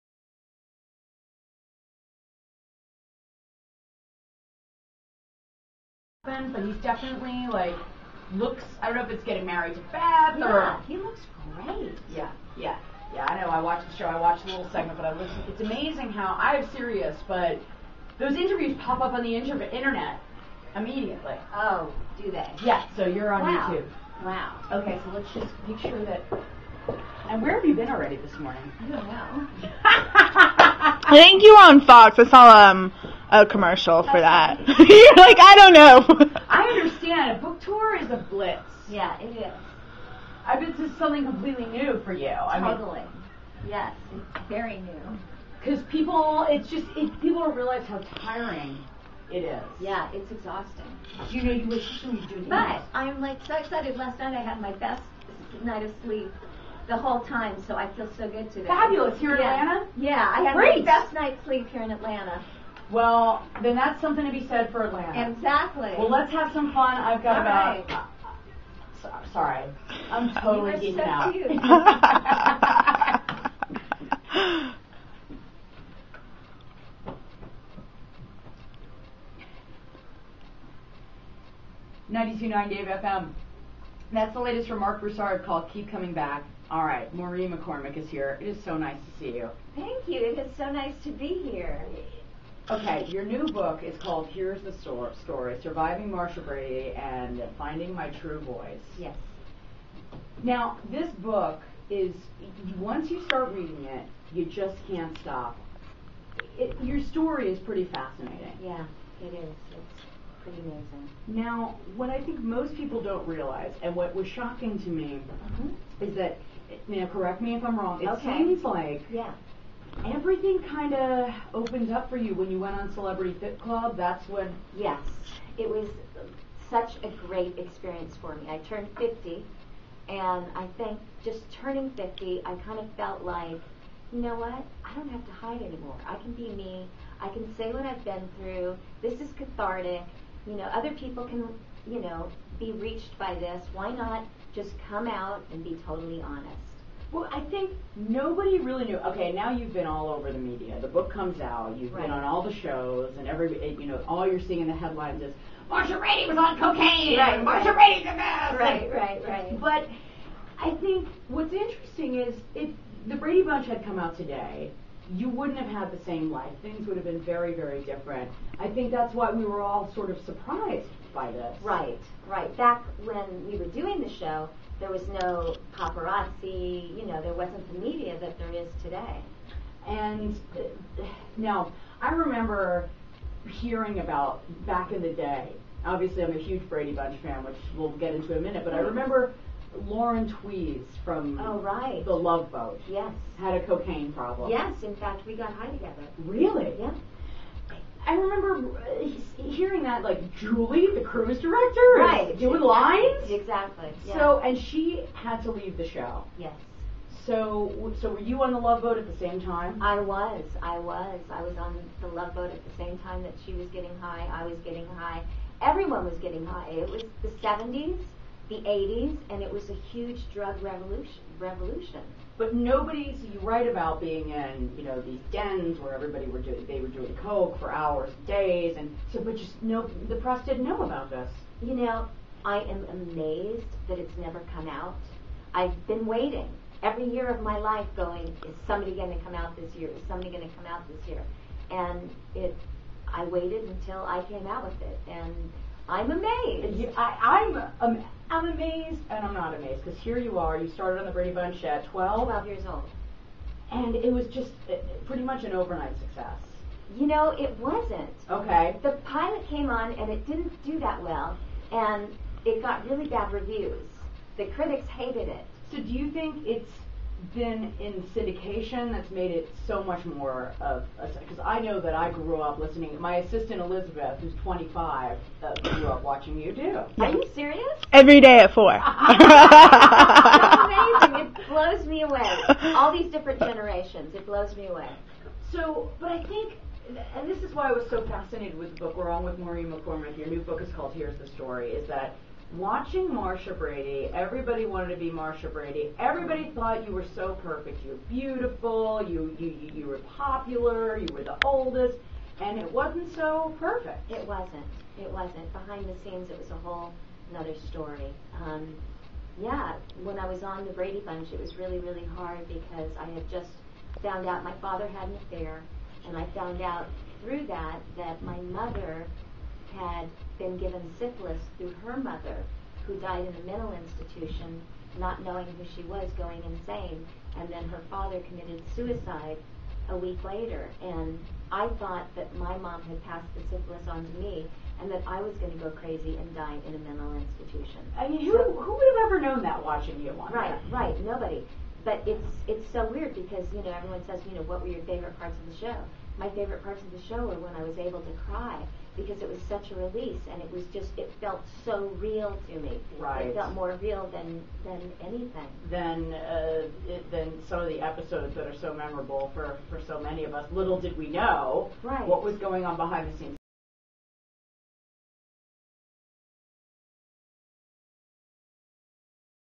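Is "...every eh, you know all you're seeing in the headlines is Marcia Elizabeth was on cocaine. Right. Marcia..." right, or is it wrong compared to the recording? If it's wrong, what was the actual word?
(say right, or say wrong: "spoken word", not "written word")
wrong: "Brady", not "Elizabeth".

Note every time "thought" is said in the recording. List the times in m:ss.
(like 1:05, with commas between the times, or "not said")
4:56, 5:31.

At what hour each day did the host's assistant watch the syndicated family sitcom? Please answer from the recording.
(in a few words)
4.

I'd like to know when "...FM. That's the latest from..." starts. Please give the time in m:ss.
1:22.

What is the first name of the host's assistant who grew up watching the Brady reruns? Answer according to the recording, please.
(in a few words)
Elizabeth.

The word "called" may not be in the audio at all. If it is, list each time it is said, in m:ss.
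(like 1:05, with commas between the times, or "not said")
1:25, 1:33, 4:50.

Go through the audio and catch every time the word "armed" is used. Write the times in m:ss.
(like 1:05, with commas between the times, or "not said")
not said.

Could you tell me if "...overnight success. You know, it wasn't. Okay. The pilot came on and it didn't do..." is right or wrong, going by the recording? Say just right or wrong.
right.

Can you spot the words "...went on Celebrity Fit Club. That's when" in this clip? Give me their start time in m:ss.
2:02.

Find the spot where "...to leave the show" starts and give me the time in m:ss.
3:25.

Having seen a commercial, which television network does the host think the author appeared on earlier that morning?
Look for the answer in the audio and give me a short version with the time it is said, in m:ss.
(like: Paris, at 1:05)
Fox, at 0:31.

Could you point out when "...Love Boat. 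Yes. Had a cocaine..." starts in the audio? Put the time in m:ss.
3:12.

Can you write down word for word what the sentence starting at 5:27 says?
And then her father committed suicide a week later.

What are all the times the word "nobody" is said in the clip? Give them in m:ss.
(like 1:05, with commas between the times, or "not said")
2:27, 3:42, 5:41.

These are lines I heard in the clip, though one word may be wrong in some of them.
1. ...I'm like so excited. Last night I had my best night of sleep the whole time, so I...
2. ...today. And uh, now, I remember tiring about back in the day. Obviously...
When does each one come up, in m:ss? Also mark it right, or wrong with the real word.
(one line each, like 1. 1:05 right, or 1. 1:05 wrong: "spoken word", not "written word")
1. 0:52 right
2. 2:58 wrong: "hearing", not "tiring".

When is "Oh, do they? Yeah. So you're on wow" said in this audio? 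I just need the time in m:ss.
0:21.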